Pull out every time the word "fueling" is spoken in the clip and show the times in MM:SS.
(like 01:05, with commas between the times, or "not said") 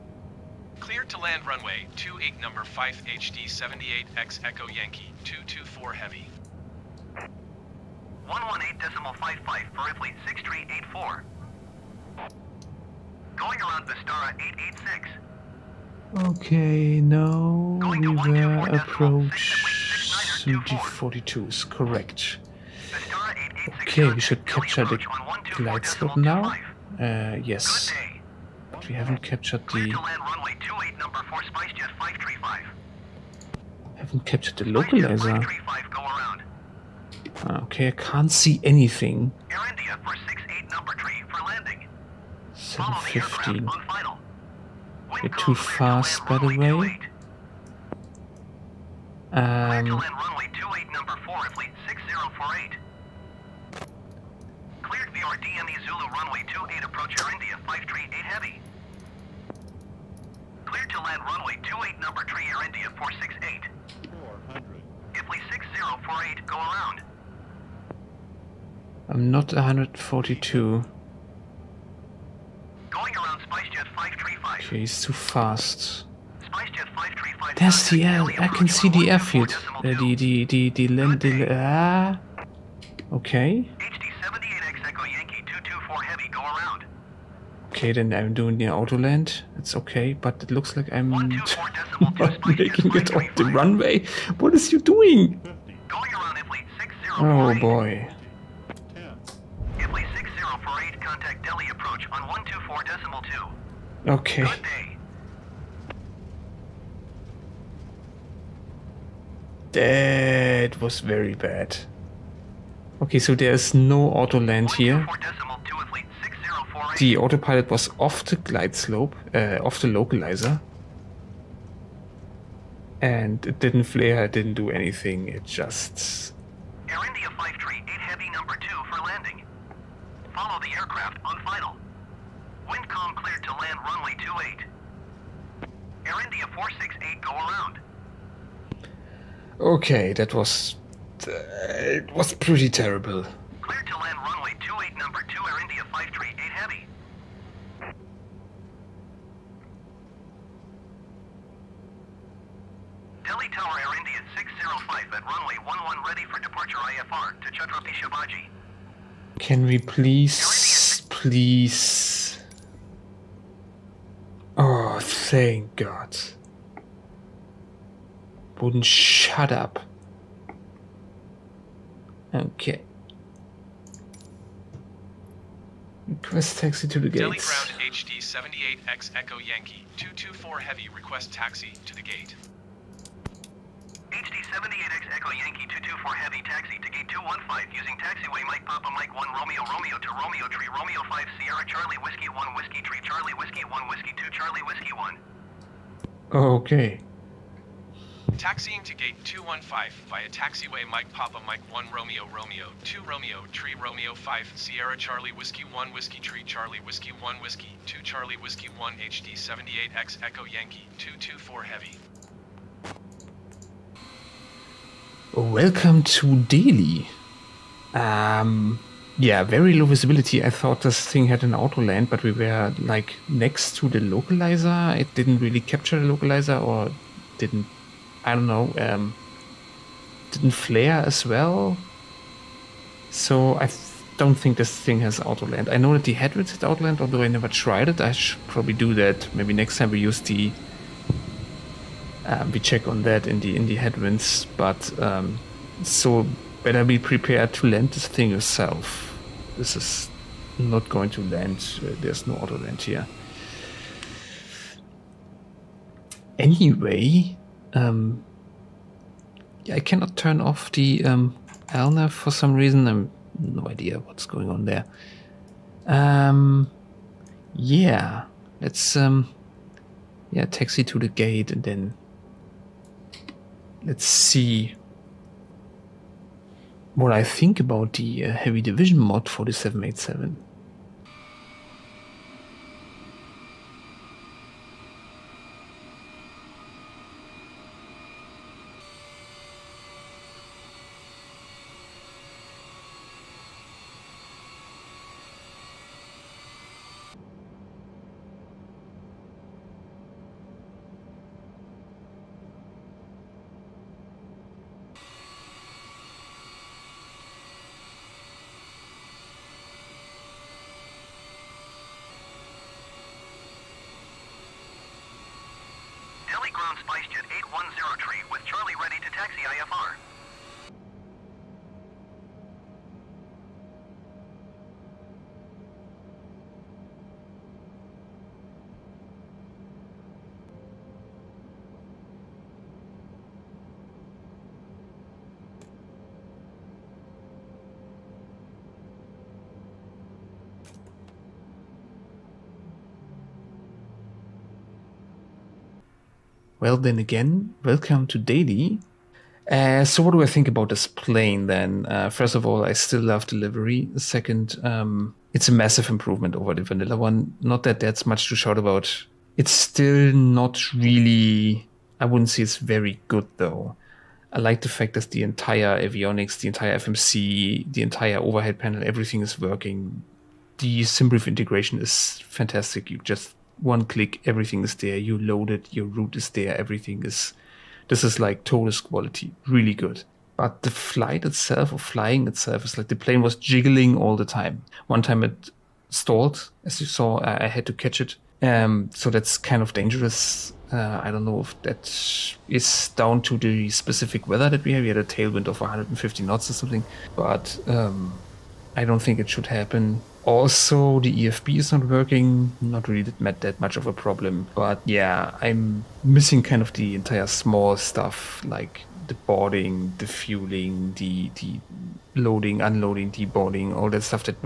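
06:50.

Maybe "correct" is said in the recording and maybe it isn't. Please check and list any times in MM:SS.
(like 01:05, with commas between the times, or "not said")
00:21.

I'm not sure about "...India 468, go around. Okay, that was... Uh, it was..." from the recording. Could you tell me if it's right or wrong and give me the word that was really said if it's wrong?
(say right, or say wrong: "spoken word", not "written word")
right.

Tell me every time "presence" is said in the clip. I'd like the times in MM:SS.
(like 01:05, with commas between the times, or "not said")
not said.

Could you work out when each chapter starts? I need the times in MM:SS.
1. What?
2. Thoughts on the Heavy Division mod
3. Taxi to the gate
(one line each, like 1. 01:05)
1. 03:03
2. 05:46
3. 03:34.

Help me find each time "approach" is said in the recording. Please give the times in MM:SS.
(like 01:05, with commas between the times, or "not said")
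00:18, 00:56.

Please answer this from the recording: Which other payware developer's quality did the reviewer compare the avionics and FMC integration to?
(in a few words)
ToLiss.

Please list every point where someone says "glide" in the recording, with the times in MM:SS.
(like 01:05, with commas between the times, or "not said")
00:25, 01:58.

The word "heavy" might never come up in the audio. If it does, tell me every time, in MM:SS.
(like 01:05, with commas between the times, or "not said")
00:05, 00:58, 02:07, 03:00, 03:06, 03:31, 04:38.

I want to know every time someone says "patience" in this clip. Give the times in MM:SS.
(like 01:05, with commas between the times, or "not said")
not said.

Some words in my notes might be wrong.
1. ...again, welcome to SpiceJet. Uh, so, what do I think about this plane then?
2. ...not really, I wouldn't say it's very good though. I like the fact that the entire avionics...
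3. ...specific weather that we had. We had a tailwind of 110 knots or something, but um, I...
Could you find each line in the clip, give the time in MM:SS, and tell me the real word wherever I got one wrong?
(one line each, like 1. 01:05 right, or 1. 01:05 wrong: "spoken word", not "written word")
1. 05:46 wrong: "Delhi", not "SpiceJet"
2. 06:00 right
3. 06:33 wrong: "150", not "110".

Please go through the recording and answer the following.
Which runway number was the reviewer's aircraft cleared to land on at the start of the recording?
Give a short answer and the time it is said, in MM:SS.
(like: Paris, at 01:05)
28, at 00:01.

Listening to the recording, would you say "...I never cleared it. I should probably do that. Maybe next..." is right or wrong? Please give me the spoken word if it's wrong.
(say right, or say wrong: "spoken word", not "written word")
wrong: "tried", not "cleared".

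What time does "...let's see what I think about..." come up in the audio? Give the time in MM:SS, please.
04:33.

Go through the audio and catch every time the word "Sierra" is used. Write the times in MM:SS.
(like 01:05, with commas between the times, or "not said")
03:11, 03:24.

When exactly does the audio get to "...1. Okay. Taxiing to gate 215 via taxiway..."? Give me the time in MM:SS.
03:14.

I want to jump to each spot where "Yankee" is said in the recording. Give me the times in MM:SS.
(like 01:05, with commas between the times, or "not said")
00:04, 02:59, 03:05, 03:30.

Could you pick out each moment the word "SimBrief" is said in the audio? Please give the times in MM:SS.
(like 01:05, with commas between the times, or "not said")
06:10.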